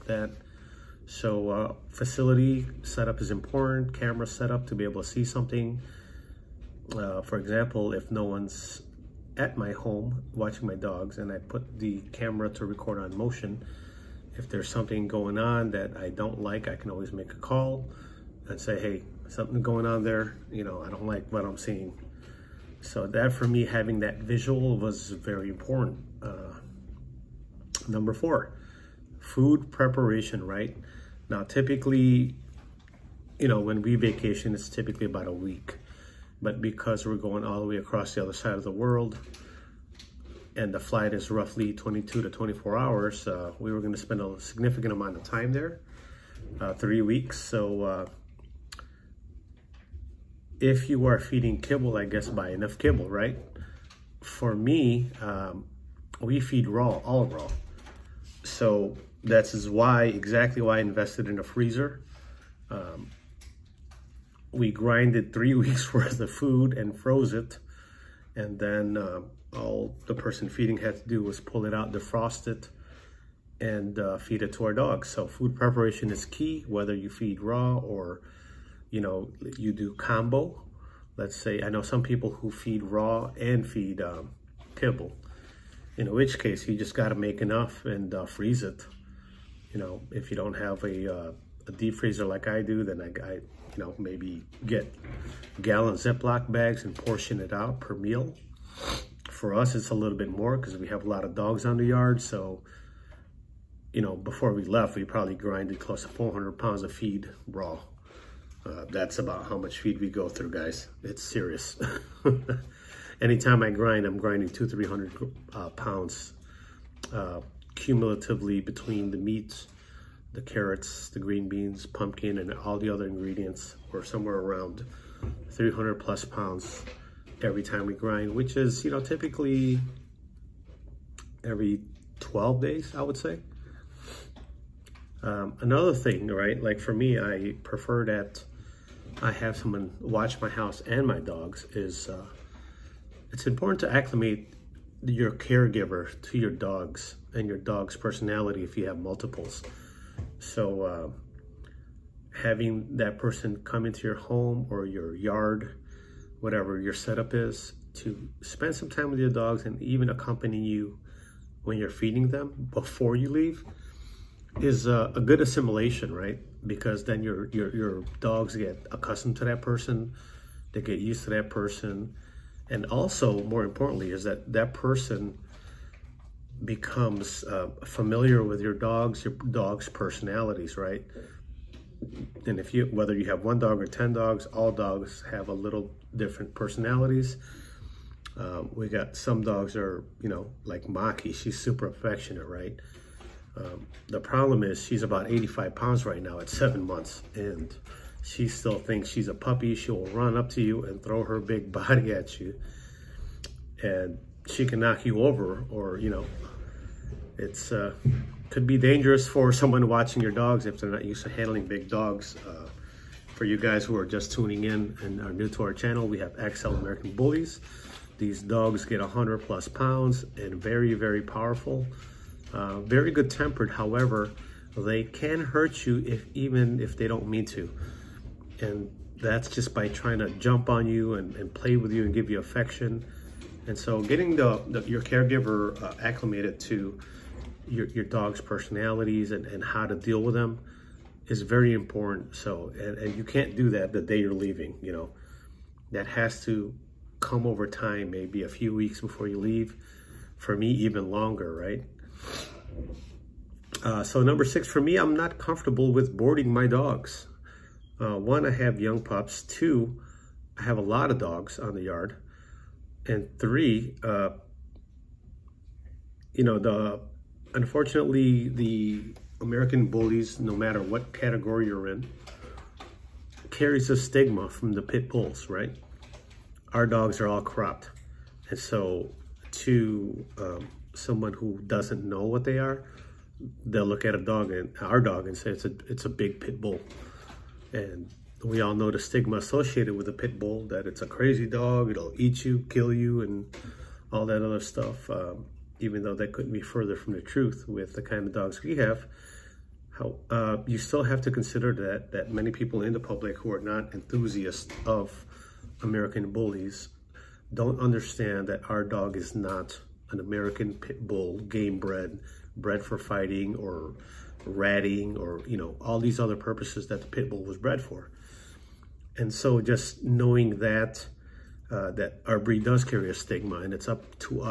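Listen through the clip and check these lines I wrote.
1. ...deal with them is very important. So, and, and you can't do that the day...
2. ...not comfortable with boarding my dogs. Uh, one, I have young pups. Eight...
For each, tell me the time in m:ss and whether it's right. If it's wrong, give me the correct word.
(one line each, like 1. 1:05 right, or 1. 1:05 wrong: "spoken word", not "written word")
1. 3:59 right
2. 4:15 wrong: "Two", not "Eight".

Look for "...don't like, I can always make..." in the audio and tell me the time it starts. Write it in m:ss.
0:16.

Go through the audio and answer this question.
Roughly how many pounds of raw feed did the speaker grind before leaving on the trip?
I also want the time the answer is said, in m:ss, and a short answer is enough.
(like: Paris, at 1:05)
400 pounds, at 1:46.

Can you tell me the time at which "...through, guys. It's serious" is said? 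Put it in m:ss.
1:50.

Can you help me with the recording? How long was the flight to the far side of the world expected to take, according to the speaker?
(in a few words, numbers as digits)
22 to 24 hours.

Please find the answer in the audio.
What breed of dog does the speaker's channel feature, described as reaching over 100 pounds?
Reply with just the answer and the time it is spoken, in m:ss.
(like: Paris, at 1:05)
XL American Bullies, at 3:36.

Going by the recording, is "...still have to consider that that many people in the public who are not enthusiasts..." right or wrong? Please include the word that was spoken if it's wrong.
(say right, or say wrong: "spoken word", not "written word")
right.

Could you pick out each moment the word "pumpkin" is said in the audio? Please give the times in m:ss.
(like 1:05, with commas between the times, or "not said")
2:01.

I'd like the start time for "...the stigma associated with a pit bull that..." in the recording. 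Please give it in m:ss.
4:48.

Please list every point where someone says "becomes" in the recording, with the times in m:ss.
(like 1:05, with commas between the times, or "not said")
2:56.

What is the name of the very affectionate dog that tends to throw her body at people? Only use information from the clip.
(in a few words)
Maki.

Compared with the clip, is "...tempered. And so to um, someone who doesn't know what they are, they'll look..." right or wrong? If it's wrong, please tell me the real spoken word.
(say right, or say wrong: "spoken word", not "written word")
wrong: "cropped", not "tempered".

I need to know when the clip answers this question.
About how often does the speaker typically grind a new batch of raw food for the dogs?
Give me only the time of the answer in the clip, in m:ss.
2:11.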